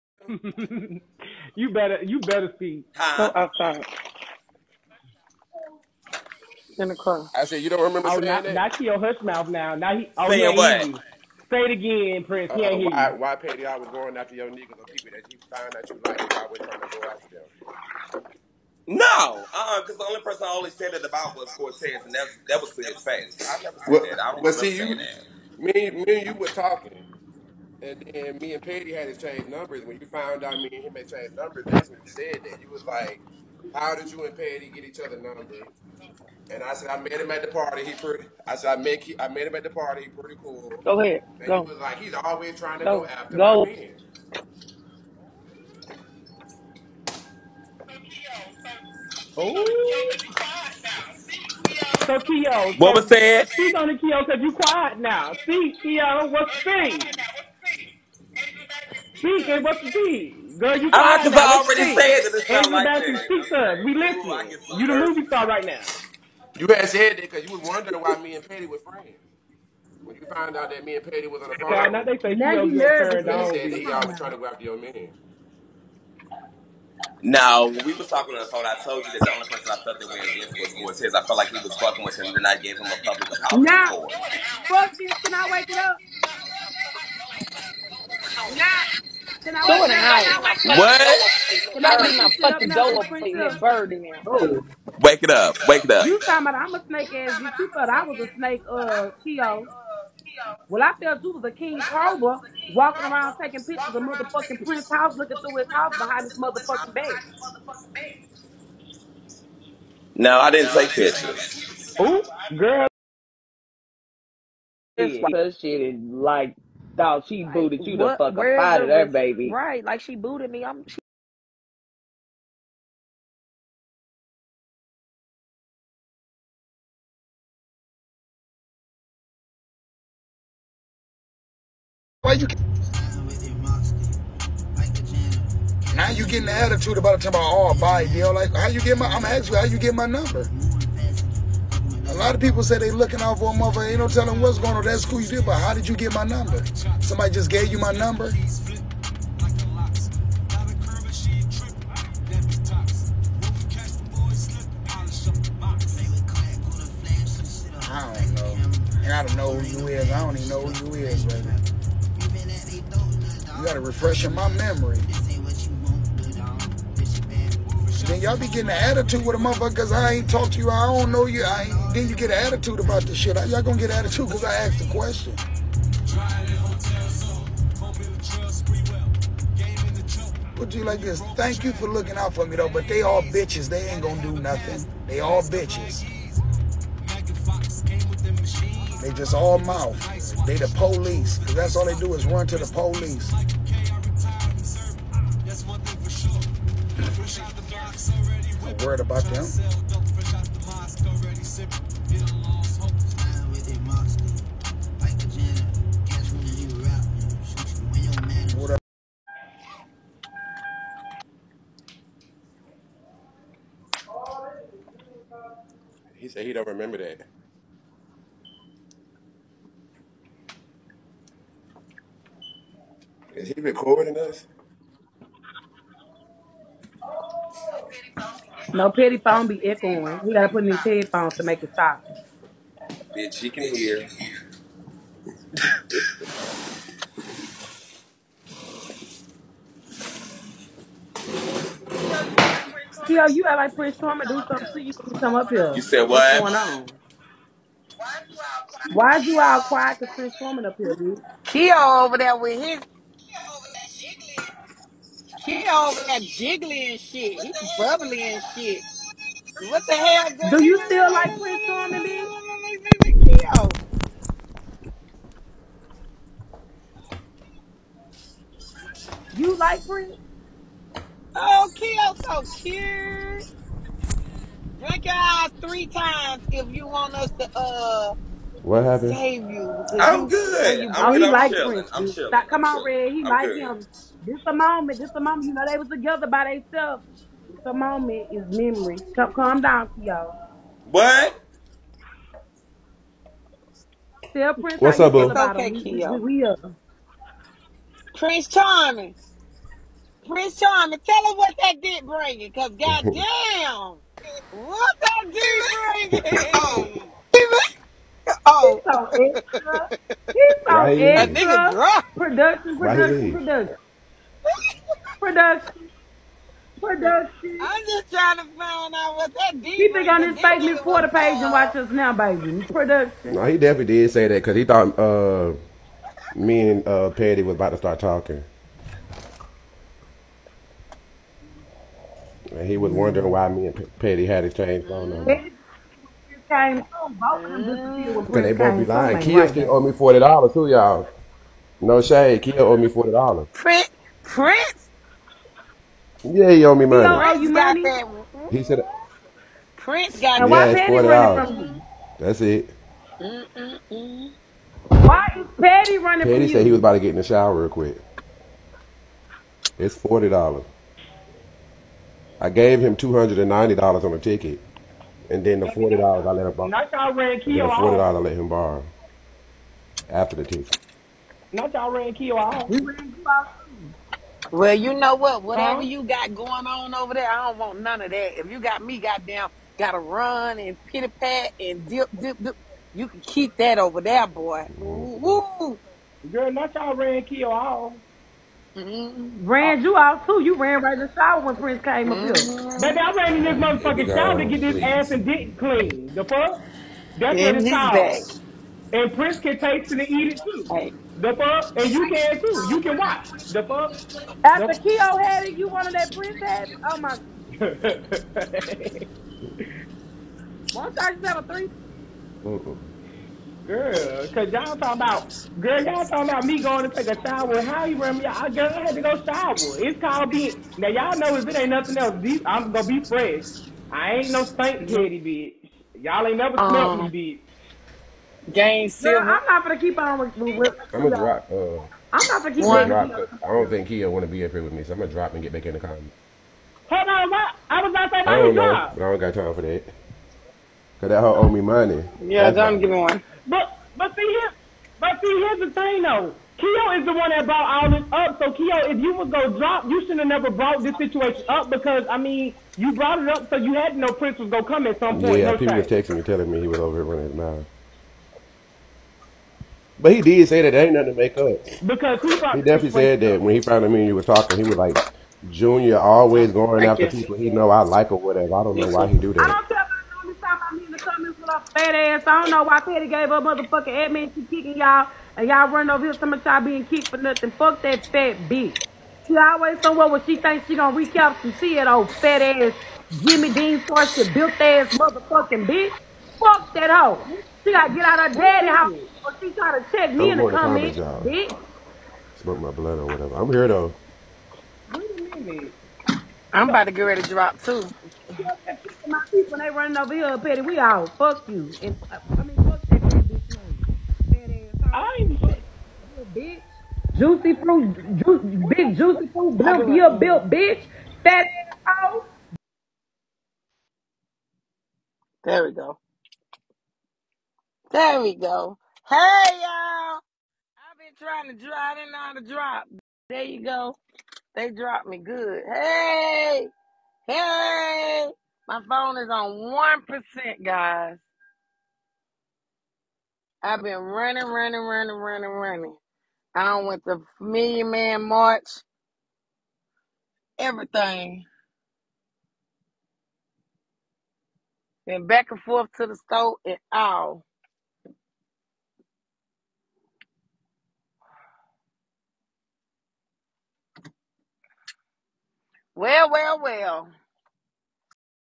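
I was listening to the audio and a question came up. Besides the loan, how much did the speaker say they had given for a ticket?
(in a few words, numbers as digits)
$290.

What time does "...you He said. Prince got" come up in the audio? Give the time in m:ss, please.
5:48.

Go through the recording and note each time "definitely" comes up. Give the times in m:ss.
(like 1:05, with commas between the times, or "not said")
5:23, 7:42.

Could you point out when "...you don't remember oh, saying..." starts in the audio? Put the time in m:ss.
0:07.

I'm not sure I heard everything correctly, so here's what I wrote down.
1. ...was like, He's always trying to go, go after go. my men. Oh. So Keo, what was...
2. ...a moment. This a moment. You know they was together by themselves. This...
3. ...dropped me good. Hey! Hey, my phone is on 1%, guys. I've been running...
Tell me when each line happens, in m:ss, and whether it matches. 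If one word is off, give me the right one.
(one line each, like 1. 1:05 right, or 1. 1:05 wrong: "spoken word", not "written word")
1. 0:41 right
2. 4:44 right
3. 8:44 right.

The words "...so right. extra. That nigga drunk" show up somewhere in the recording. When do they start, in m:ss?
5:10.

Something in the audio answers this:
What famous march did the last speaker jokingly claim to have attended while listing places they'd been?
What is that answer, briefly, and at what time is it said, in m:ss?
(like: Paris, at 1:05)
Million Man March, at 8:57.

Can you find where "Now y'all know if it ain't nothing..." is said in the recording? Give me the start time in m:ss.
7:00.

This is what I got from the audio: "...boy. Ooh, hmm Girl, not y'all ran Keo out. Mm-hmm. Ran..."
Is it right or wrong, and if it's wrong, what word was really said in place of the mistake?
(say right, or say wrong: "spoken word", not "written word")
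right.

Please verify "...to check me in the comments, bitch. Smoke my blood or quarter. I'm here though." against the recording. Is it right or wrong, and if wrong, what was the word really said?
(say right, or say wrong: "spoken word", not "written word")
wrong: "whatever", not "quarter".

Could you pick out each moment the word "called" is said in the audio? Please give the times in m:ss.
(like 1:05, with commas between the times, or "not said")
6:38, 7:00.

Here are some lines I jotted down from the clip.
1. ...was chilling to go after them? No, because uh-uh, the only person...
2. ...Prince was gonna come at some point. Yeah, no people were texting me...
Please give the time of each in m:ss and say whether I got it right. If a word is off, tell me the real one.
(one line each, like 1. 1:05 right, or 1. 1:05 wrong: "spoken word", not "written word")
1. 0:16 wrong: "trying", not "chilling"
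2. 7:34 right.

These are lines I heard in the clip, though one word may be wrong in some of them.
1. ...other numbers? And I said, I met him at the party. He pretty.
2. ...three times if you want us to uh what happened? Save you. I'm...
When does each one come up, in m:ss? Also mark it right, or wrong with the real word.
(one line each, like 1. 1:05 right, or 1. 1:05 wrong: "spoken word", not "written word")
1. 0:34 right
2. 4:35 right.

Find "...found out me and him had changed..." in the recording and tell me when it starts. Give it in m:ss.
0:30.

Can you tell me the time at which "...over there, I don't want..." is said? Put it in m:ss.
6:16.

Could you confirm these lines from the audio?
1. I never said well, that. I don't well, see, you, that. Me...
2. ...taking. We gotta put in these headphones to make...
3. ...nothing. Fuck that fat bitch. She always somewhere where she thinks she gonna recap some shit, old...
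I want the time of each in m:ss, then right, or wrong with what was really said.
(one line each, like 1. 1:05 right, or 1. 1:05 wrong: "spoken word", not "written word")
1. 0:23 right
2. 3:49 wrong: "echoing", not "taking"
3. 7:57 right.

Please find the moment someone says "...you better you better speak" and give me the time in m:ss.
0:01.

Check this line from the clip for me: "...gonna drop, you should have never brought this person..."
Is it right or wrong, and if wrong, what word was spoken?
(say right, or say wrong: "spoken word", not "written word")
wrong: "situation", not "person".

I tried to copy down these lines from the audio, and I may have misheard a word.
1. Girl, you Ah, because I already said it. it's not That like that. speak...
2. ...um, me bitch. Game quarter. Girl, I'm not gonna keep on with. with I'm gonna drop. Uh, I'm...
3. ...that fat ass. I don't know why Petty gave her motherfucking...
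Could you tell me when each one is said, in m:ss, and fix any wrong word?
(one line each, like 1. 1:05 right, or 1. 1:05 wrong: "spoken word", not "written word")
1. 1:00 wrong: "Andrew", not "That"
2. 7:07 wrong: "silver", not "quarter"
3. 7:49 right.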